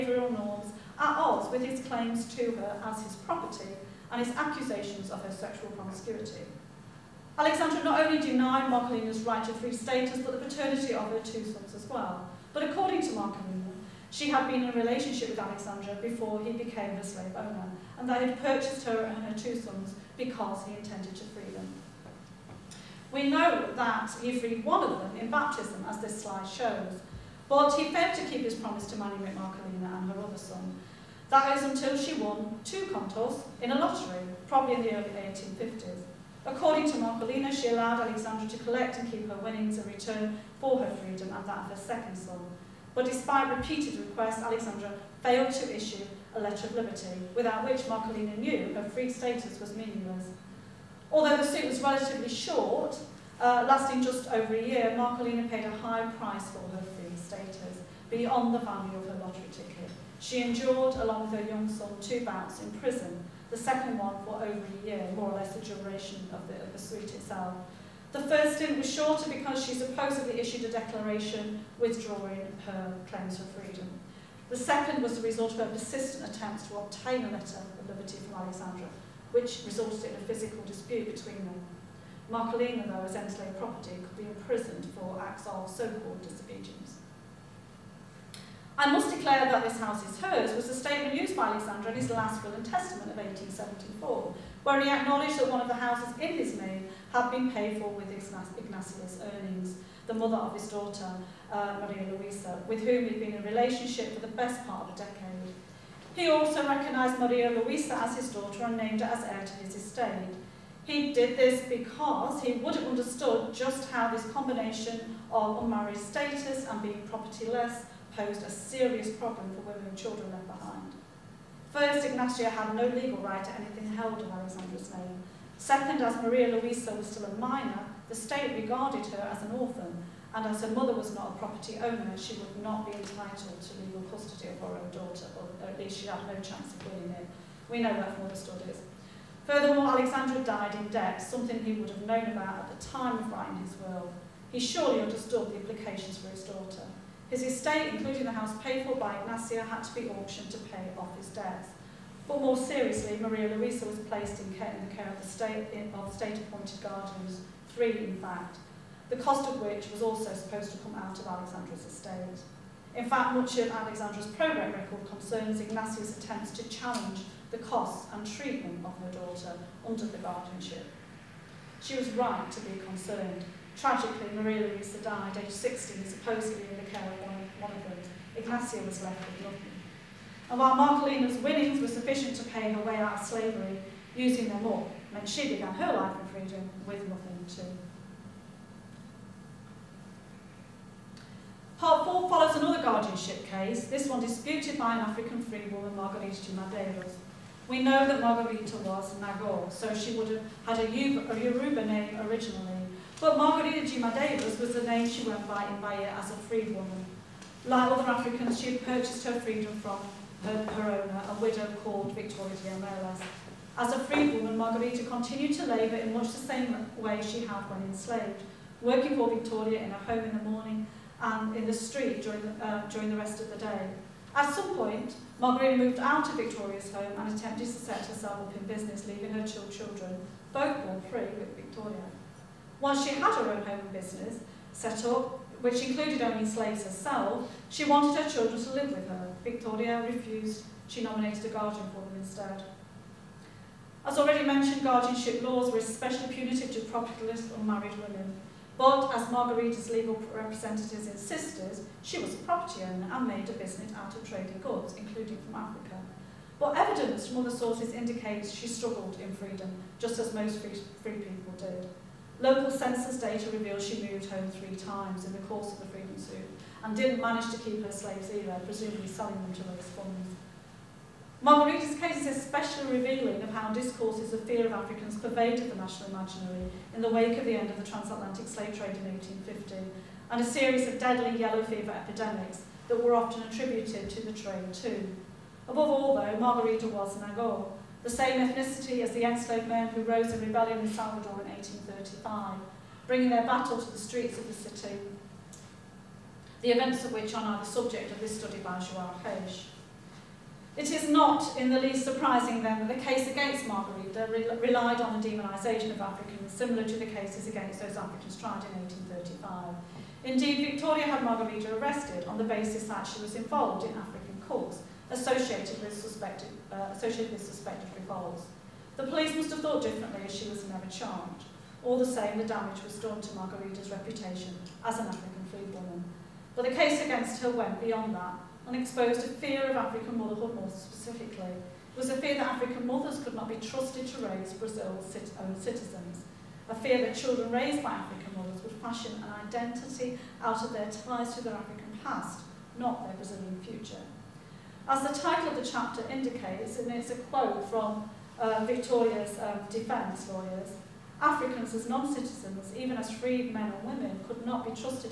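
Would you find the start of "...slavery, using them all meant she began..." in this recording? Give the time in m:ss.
3:03.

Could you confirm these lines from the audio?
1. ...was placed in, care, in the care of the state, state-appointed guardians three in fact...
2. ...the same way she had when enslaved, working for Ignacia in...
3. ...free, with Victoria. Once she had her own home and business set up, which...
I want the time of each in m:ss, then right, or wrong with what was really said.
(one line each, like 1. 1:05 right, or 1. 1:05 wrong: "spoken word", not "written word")
1. 2:33 right
2. 3:36 wrong: "Victoria", not "Ignacia"
3. 3:51 right.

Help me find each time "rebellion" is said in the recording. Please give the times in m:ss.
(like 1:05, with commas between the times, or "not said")
4:50.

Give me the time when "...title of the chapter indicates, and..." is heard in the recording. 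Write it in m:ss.
5:45.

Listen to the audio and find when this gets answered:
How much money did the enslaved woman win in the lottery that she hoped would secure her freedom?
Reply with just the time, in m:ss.
0:32.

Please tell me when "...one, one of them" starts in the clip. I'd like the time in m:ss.
2:57.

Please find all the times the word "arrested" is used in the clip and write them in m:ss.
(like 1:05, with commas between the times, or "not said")
5:11.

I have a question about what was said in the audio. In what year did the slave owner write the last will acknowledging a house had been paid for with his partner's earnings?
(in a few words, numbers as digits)
1874.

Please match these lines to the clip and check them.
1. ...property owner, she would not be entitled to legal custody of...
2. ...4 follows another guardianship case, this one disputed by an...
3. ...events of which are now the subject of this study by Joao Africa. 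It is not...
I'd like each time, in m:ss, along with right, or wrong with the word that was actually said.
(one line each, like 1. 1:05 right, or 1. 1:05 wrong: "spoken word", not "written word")
1. 2:11 right
2. 3:12 right
3. 4:56 wrong: "Page", not "Africa".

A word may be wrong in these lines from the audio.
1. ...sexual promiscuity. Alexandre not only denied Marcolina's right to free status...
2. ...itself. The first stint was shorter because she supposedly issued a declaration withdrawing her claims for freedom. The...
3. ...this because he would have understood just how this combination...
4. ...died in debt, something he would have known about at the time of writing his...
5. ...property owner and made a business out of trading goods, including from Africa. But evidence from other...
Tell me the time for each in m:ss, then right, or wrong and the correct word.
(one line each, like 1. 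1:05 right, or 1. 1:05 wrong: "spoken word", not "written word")
1. 0:05 right
2. 1:07 right
3. 1:51 right
4. 2:20 right
5. 4:12 right.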